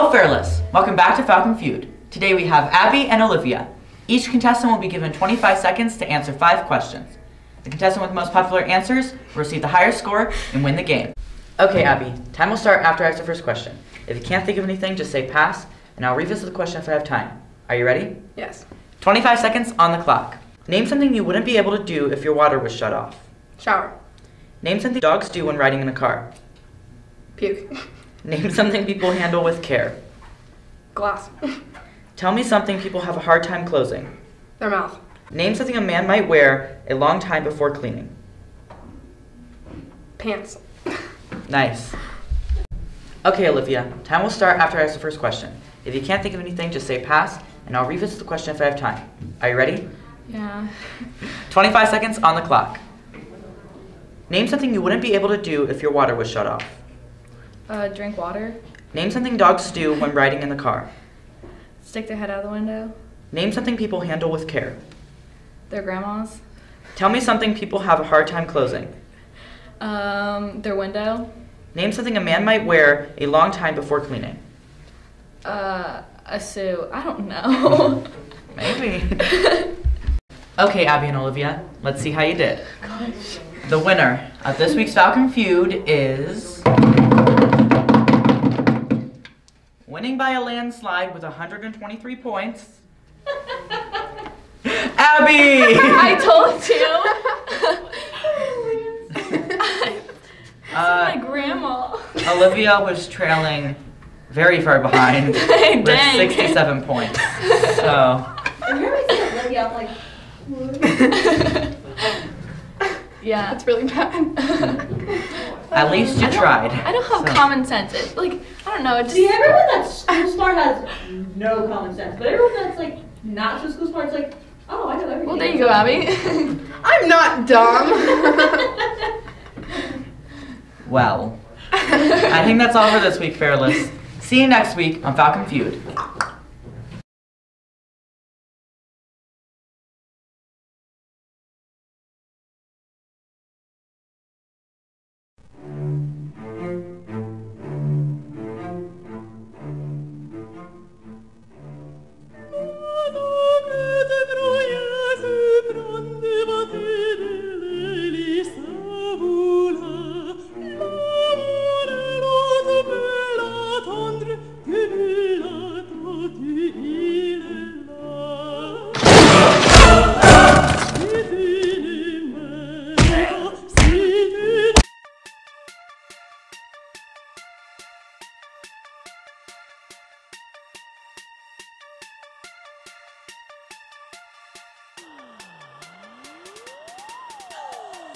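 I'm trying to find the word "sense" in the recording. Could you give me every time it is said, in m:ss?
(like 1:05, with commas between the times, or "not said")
1:57, 2:01.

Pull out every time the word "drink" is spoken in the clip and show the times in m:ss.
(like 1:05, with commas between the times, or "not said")
0:57.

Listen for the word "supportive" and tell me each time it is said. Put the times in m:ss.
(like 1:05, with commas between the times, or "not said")
not said.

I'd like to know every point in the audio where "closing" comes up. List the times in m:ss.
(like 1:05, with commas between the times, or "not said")
0:33, 1:08.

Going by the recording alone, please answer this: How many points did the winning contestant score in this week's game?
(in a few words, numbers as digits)
123.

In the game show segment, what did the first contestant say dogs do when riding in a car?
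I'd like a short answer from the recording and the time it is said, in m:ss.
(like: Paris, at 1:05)
Puke, at 0:27.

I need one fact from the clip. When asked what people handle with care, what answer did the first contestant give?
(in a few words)
Glass.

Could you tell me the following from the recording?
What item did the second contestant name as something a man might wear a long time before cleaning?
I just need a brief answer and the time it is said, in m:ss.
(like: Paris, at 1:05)
A suit, at 1:16.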